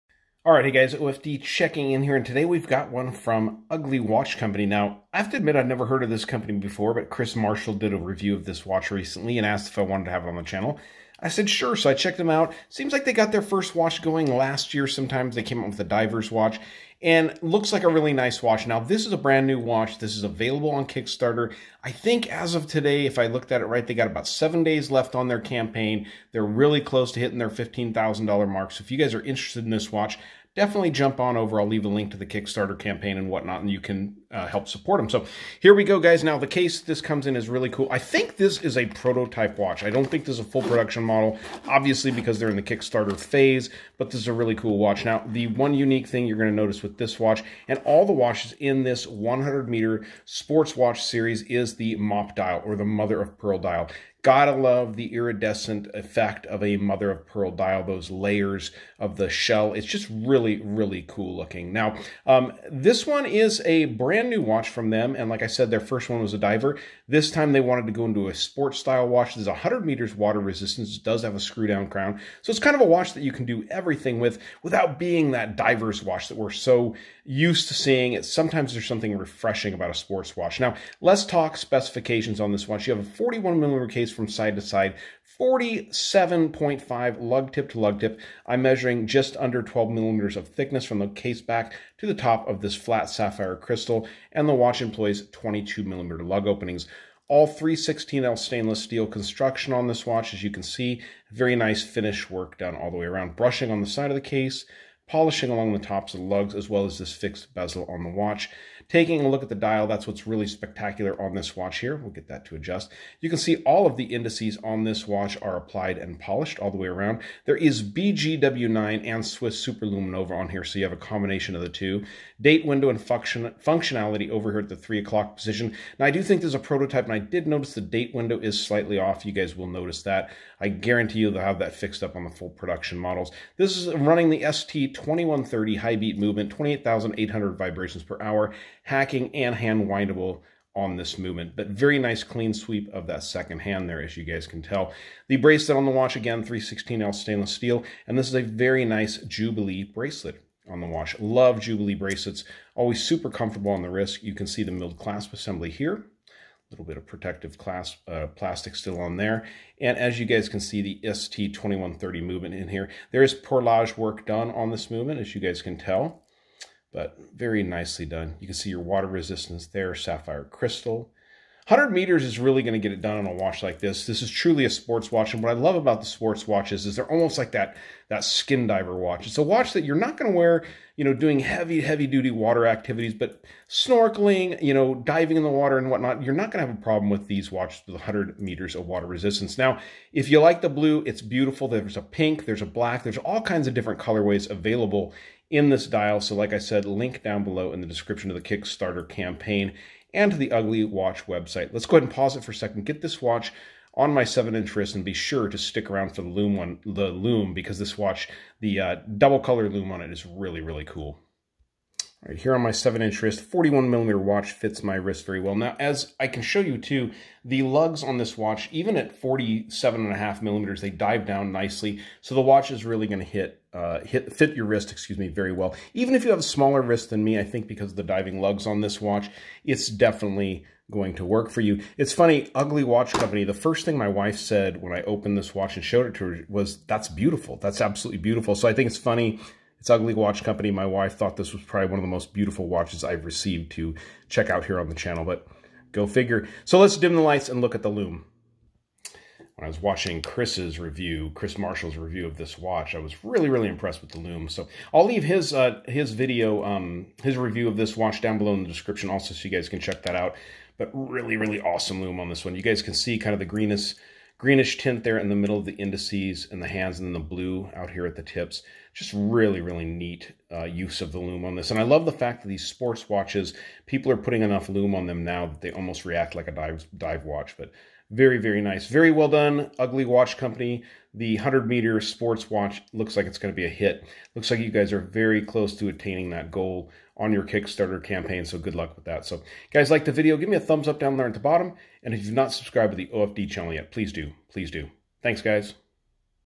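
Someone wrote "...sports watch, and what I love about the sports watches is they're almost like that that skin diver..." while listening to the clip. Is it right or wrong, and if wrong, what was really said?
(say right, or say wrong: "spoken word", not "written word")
right.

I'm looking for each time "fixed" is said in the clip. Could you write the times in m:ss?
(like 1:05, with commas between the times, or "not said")
1:47, 2:11.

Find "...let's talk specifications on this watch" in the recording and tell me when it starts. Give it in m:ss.
1:21.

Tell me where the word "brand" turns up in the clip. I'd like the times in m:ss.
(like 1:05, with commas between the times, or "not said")
0:19, 1:03.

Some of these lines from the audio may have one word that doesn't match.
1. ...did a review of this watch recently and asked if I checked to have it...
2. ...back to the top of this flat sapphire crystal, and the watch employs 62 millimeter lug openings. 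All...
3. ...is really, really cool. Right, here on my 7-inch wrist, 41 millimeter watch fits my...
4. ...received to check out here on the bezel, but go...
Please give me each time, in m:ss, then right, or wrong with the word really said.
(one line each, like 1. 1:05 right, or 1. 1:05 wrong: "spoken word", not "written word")
1. 0:07 wrong: "wanted", not "checked"
2. 1:31 wrong: "22", not "62"
3. 3:30 right
4. 4:03 wrong: "channel", not "bezel".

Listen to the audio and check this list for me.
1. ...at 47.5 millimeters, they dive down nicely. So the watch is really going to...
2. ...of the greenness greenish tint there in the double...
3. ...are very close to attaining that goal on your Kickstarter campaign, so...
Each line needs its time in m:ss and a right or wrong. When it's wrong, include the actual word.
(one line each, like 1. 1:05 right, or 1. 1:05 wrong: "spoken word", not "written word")
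1. 3:38 right
2. 4:23 wrong: "middle", not "double"
3. 4:44 right.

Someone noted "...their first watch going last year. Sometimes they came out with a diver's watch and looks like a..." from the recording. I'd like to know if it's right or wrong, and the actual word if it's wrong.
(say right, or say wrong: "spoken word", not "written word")
right.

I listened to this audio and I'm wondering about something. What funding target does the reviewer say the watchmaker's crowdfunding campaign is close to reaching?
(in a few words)
$15,000.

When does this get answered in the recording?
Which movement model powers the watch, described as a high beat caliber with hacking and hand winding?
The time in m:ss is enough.
2:14.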